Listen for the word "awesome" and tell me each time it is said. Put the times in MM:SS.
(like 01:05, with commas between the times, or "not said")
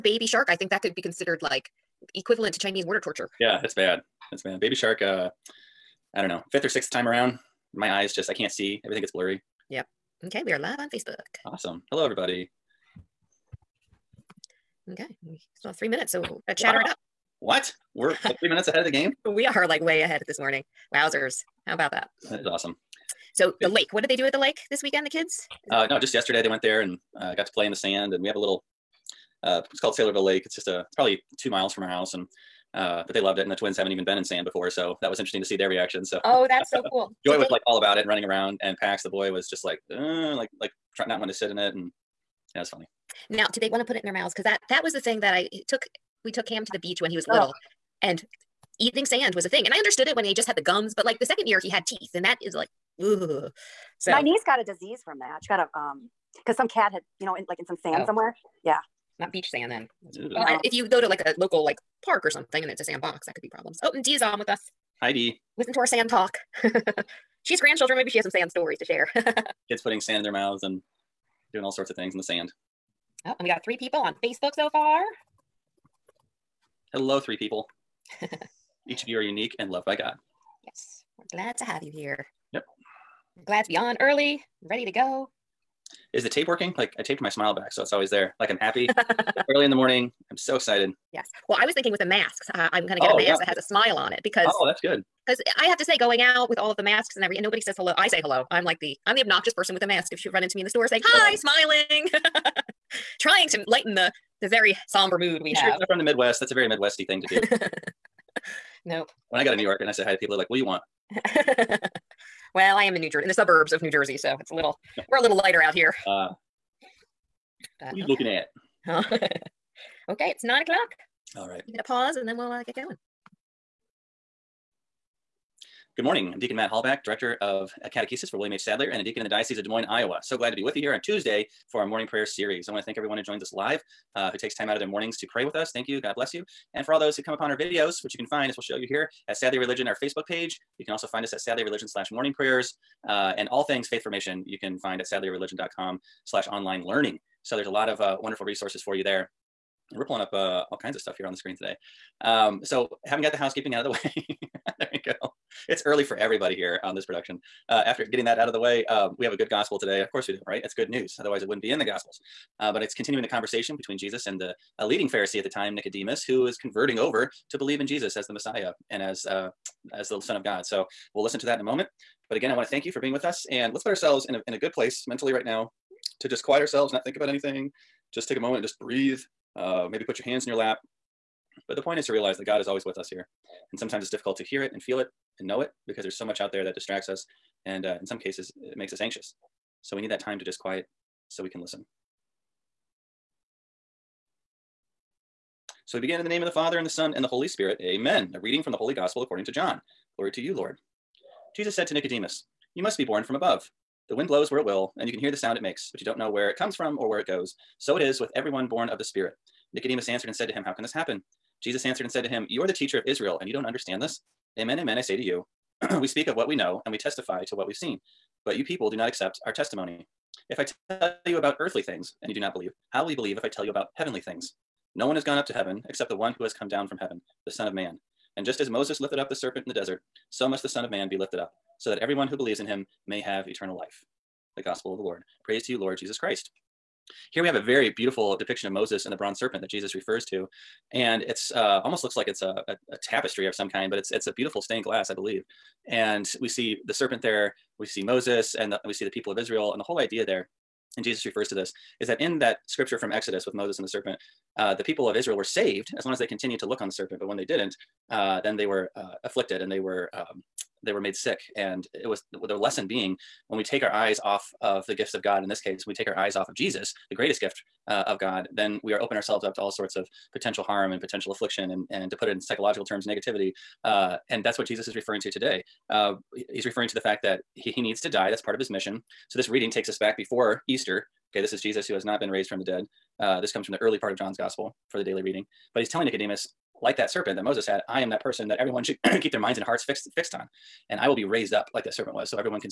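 00:11, 00:22.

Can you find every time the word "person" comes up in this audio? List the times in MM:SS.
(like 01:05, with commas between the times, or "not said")
01:39, 04:48.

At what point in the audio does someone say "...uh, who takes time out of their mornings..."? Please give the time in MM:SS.
02:14.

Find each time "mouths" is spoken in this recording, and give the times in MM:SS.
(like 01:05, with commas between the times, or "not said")
00:44, 01:10.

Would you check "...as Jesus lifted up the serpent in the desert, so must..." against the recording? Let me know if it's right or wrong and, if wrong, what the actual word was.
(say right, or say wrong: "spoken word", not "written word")
wrong: "Moses", not "Jesus".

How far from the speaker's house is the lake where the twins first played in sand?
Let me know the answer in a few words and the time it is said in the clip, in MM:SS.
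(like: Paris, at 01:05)
2 miles, at 00:31.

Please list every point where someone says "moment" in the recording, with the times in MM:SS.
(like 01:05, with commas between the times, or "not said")
02:51, 02:58.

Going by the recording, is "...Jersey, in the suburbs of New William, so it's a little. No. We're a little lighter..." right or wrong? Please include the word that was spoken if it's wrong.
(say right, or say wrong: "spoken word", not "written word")
wrong: "Jersey", not "William".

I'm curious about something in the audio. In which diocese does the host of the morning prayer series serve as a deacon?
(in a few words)
Des Moines, Iowa.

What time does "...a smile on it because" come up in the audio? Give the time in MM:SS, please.
01:33.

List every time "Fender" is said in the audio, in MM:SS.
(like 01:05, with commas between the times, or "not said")
not said.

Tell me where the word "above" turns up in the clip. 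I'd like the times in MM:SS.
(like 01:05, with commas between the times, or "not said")
03:23.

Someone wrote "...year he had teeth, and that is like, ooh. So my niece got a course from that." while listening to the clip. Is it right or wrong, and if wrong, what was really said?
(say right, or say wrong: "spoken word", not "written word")
wrong: "disease", not "course".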